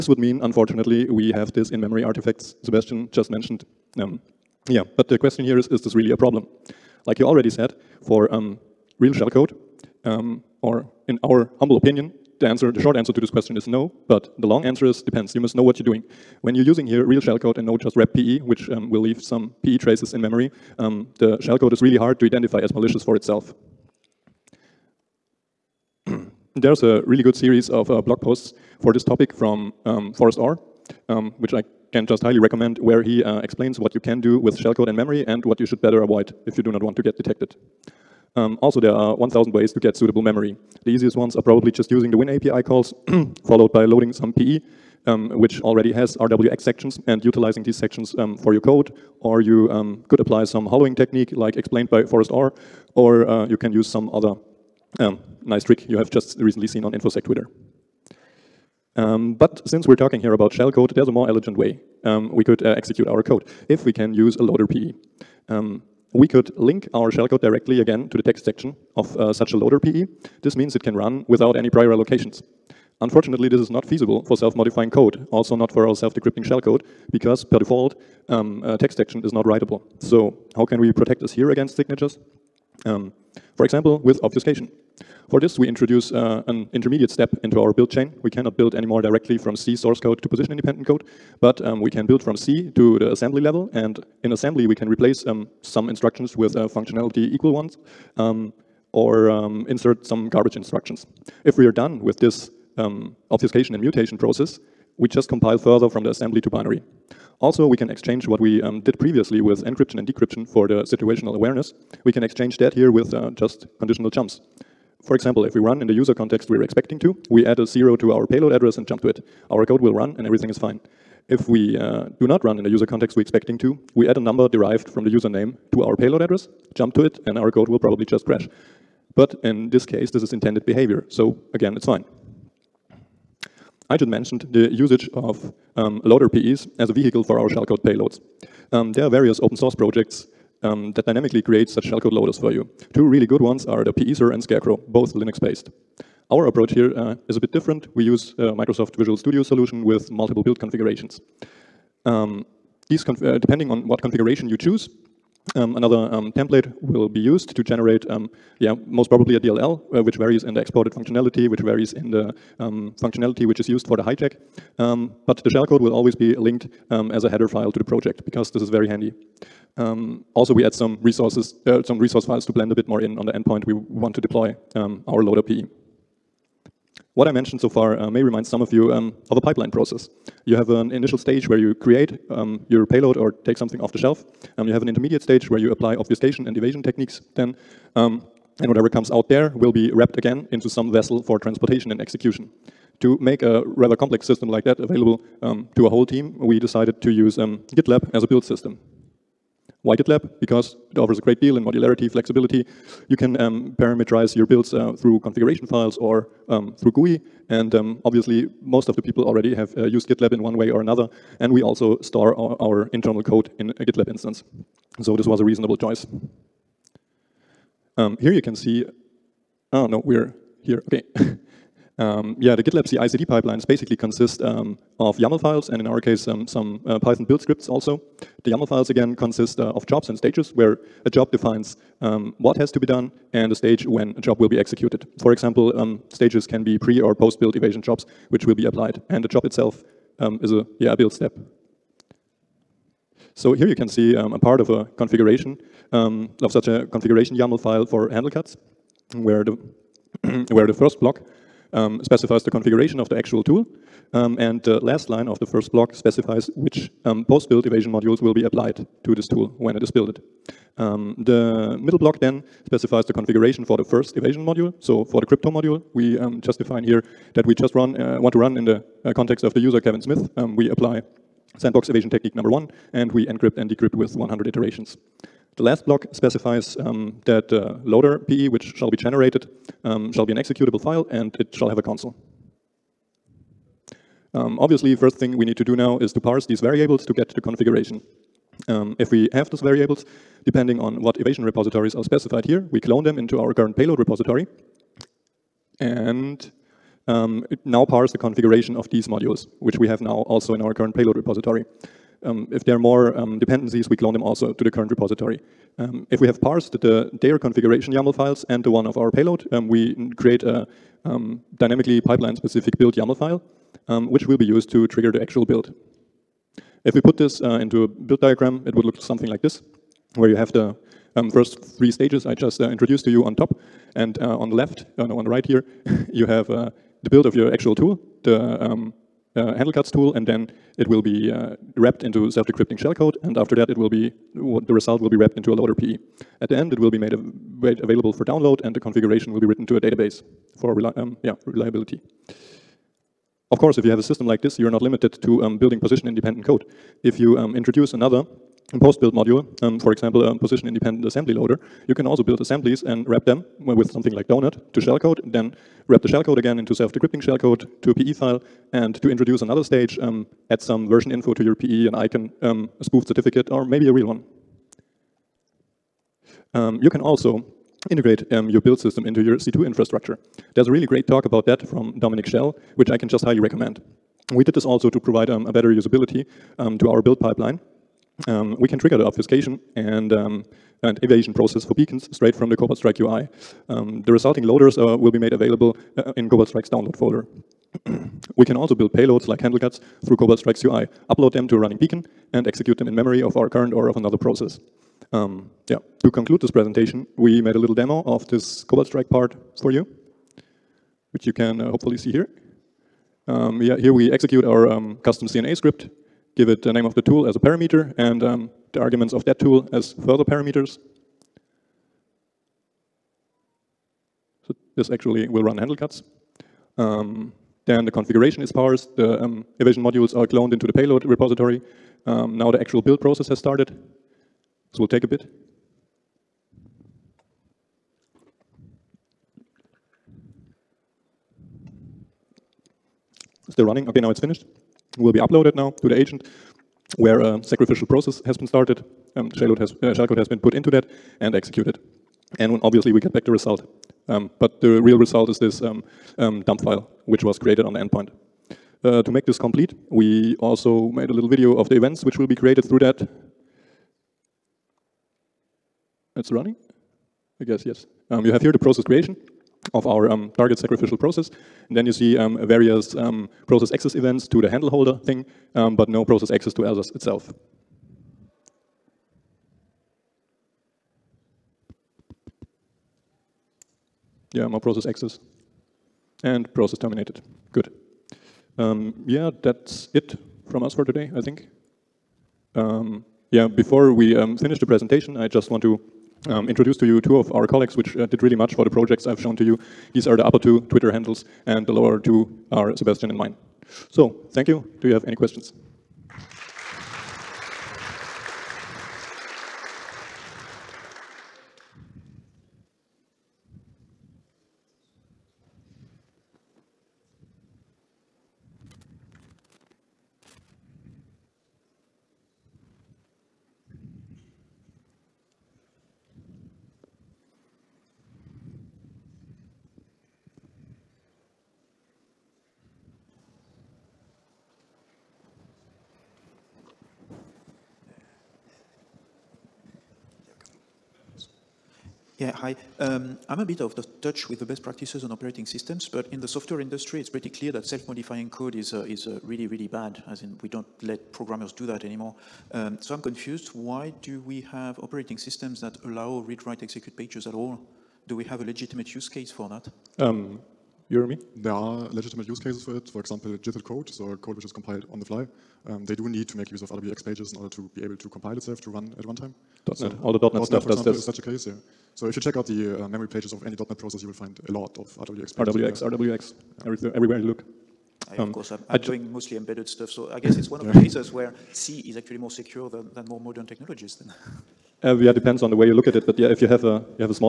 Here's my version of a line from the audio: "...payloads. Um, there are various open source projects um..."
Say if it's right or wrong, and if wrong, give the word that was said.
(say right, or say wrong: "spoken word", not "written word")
right.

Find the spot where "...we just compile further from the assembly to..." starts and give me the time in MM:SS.
01:44.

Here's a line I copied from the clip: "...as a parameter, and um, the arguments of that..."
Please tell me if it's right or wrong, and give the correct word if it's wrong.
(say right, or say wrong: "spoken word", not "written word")
right.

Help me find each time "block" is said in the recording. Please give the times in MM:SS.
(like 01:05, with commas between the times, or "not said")
04:11, 04:15, 04:21, 04:35.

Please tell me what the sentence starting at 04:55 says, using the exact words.
And um, it now parse the configuration of these modules, which we have now also in our current payload repository.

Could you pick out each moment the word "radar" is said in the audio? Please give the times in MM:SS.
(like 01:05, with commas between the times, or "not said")
not said.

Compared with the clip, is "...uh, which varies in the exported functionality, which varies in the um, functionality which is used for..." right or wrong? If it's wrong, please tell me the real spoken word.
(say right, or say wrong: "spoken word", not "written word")
right.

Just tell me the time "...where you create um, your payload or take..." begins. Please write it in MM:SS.
03:01.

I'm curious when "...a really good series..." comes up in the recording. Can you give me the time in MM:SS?
00:26.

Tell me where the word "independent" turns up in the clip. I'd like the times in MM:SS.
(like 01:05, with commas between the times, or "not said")
01:30, 05:45, 05:50.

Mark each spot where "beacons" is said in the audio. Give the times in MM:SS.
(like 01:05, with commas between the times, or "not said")
06:21, 06:31.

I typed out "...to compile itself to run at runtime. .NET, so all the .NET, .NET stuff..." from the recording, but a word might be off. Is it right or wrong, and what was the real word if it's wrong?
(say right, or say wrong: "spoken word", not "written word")
right.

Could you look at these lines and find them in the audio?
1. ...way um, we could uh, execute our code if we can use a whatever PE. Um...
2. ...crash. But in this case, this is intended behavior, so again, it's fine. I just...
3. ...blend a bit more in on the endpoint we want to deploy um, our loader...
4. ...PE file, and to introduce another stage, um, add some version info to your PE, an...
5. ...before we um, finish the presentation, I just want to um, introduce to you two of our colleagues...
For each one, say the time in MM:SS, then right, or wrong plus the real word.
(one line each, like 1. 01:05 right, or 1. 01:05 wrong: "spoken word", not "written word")
1. 01:01 wrong: "loader", not "whatever"
2. 02:08 right
3. 02:52 right
4. 05:57 right
5. 08:03 right.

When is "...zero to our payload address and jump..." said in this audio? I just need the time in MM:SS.
01:57.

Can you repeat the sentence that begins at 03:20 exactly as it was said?
Because it offers a great deal in modularity, flexibility.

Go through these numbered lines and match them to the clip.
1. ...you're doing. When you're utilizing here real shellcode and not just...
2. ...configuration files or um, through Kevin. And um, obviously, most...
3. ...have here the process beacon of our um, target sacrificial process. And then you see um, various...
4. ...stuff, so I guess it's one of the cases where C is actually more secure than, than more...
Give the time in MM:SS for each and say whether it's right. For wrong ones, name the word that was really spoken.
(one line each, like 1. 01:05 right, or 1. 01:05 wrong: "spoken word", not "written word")
1. 00:15 wrong: "using", not "utilizing"
2. 03:25 wrong: "GUI", not "Kevin"
3. 07:38 wrong: "creation", not "beacon"
4. 09:29 right.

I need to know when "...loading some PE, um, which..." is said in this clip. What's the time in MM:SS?
00:43.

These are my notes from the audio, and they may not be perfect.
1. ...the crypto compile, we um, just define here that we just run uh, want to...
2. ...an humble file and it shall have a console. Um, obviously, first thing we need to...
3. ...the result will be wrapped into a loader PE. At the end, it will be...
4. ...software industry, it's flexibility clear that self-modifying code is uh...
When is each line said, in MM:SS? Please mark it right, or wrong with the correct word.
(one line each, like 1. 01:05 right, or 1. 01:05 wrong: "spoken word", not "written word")
1. 04:25 wrong: "module", not "compile"
2. 04:40 wrong: "executable", not "humble"
3. 05:34 right
4. 08:56 wrong: "pretty", not "flexibility".